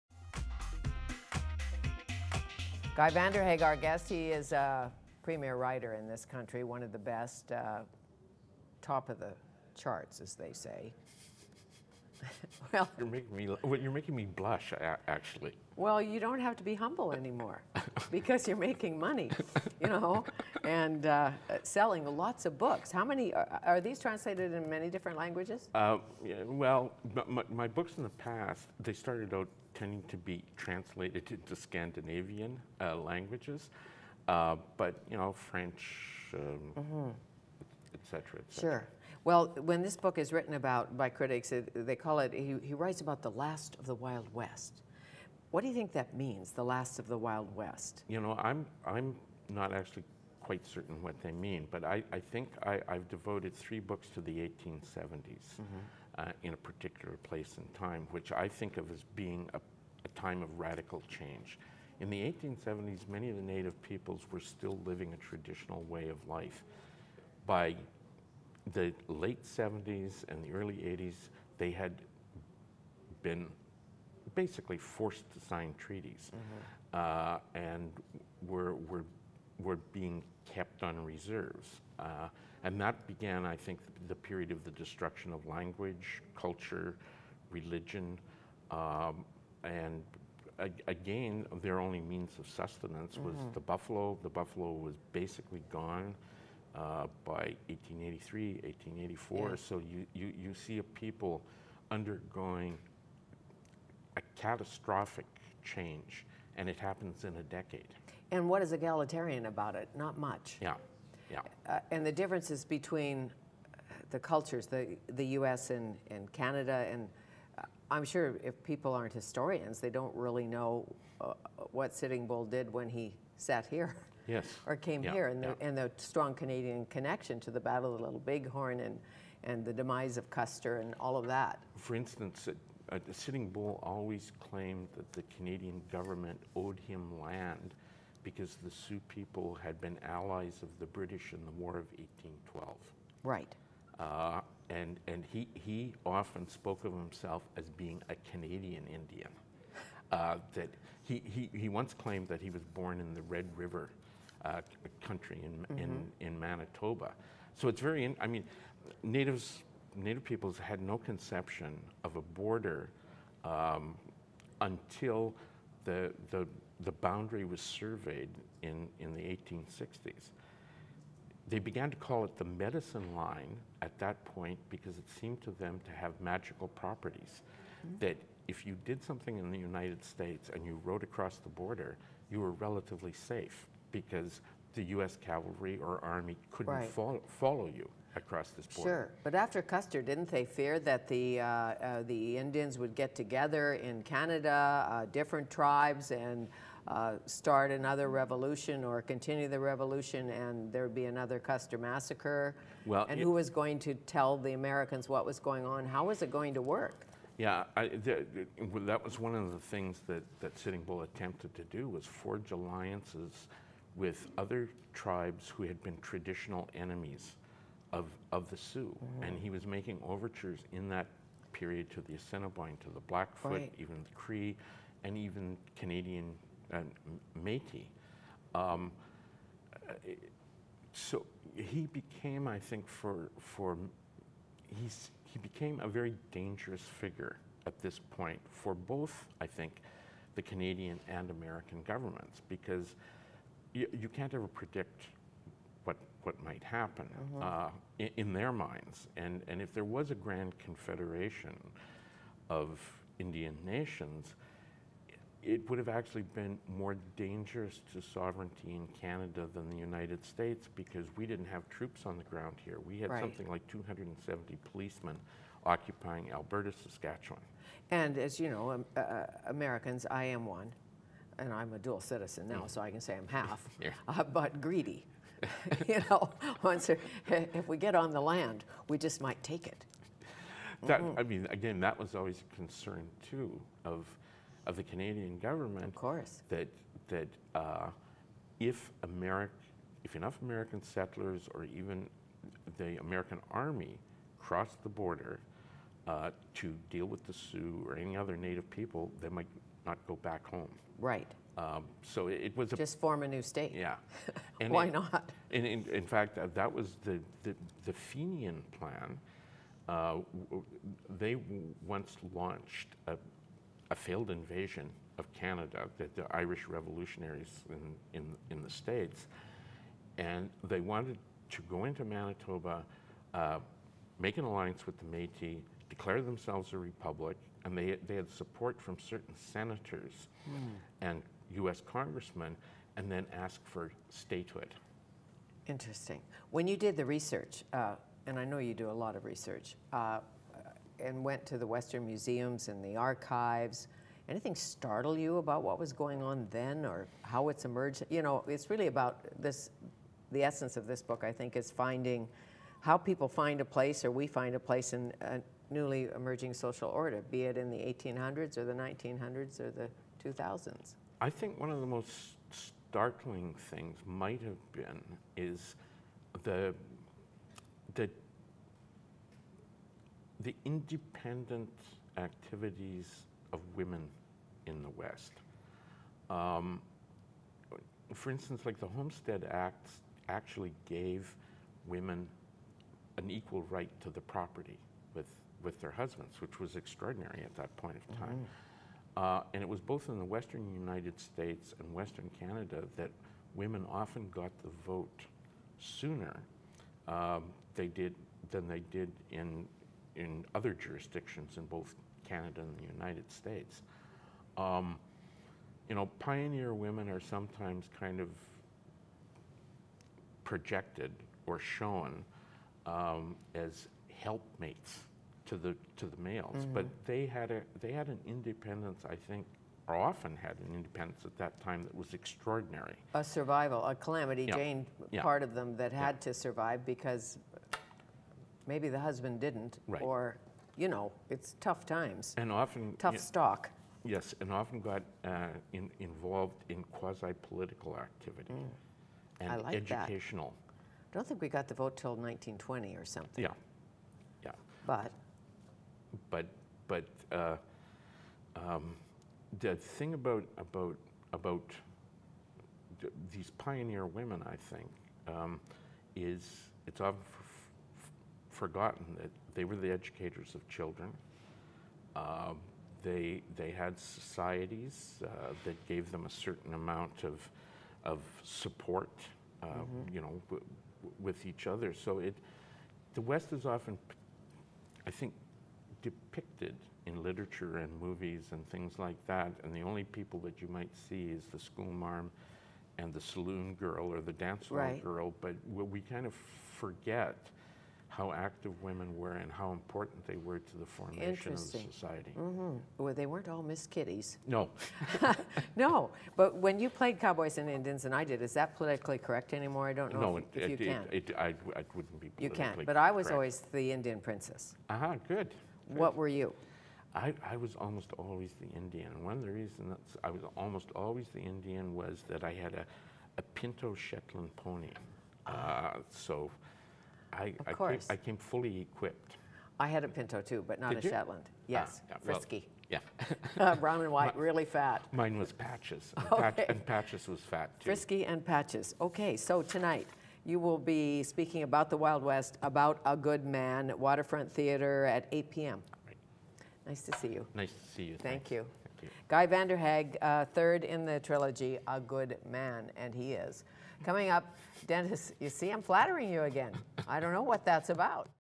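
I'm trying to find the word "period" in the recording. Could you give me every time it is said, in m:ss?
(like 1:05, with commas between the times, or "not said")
1:24, 3:41.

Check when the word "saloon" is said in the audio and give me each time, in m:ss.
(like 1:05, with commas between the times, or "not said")
8:03.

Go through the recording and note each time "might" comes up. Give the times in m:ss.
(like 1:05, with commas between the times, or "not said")
4:06, 4:39, 4:59, 6:04, 8:00.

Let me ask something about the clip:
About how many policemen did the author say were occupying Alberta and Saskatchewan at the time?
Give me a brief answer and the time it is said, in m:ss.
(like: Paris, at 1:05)
270, at 4:23.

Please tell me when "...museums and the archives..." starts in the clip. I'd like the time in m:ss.
5:42.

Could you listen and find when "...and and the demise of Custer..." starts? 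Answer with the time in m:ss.
2:08.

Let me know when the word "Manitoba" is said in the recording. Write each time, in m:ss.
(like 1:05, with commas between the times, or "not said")
2:36, 5:22.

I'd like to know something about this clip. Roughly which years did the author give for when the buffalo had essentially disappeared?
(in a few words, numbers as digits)
1883, 1884.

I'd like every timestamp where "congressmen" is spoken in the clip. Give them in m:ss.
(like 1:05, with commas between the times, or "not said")
5:31.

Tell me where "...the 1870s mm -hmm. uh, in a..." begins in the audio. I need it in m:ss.
0:54.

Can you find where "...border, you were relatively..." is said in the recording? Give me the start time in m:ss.
3:01.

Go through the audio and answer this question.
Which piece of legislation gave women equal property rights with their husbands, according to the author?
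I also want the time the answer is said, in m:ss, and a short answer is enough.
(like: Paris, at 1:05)
Homestead Act, at 6:18.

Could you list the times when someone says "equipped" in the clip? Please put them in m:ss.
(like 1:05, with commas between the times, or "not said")
8:38.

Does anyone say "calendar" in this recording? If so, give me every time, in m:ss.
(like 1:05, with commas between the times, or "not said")
not said.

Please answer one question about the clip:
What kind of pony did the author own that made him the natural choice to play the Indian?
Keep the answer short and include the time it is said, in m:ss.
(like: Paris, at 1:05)
pinto Shetland pony, at 8:33.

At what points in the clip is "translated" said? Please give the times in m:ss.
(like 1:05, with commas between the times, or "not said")
0:23, 0:30.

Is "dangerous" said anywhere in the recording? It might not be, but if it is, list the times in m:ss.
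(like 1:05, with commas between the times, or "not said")
3:56, 4:17.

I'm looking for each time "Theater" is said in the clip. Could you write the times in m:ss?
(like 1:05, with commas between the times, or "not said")
8:54.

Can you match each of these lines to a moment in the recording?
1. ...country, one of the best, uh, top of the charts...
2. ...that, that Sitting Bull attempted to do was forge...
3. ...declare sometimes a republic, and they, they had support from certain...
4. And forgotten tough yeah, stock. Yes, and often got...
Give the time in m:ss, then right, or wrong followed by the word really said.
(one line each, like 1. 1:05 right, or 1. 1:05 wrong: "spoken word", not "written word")
1. 0:06 right
2. 3:30 right
3. 5:25 wrong: "themselves", not "sometimes"
4. 7:12 wrong: "often", not "forgotten".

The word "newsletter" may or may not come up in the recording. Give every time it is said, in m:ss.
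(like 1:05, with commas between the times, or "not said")
not said.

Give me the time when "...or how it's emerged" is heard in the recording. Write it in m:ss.
5:46.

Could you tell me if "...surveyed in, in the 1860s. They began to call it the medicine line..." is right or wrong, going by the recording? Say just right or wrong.
right.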